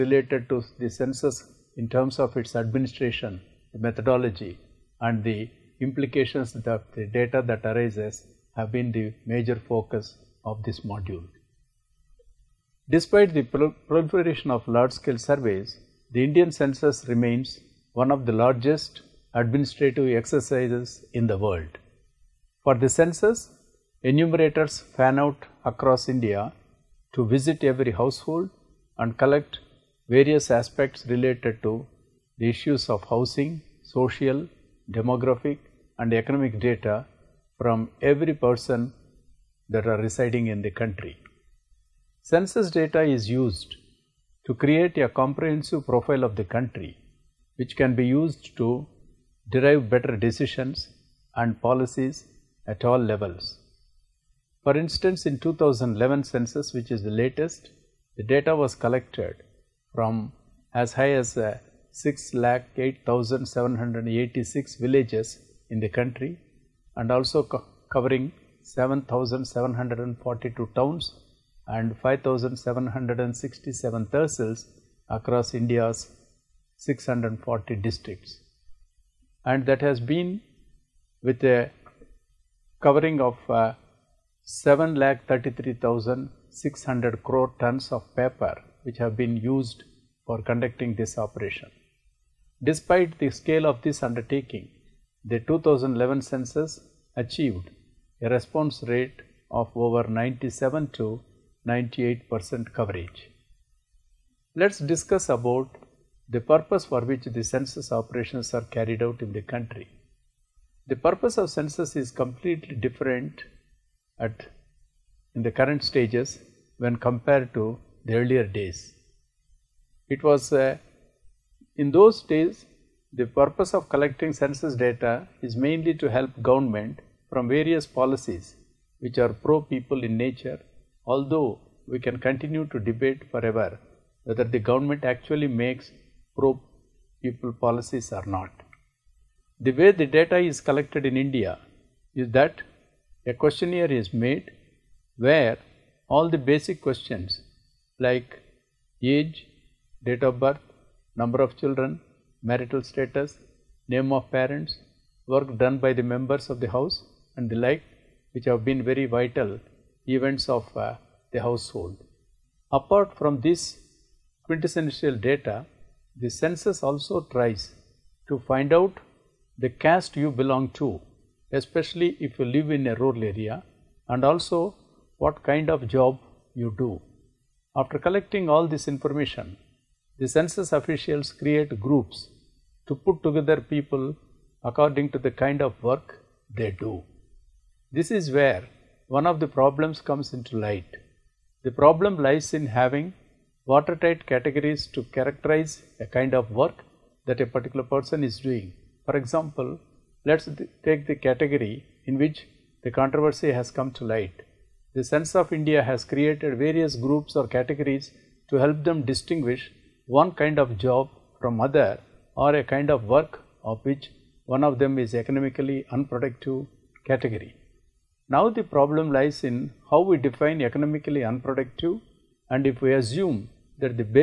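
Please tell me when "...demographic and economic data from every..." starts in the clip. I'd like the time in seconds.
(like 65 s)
34 s.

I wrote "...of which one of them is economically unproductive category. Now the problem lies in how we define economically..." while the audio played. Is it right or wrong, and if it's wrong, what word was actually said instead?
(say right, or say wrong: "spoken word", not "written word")
right.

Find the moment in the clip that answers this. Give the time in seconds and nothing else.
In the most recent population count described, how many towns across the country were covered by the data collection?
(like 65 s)
68 s.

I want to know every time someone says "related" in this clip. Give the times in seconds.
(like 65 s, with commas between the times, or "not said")
0 s, 31 s.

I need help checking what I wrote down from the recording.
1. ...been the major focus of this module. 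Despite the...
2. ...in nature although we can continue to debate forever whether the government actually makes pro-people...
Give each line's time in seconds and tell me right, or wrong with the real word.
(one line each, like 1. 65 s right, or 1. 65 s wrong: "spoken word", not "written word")
1. 8 s right
2. 130 s right.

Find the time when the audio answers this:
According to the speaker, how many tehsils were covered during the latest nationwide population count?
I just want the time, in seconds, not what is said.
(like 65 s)
72 s.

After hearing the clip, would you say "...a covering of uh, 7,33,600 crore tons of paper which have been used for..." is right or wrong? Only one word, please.
right.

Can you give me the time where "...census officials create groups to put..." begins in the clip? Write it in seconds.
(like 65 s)
180 s.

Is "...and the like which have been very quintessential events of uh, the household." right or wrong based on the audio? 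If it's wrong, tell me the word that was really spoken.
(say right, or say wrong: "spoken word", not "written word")
wrong: "vital", not "quintessential".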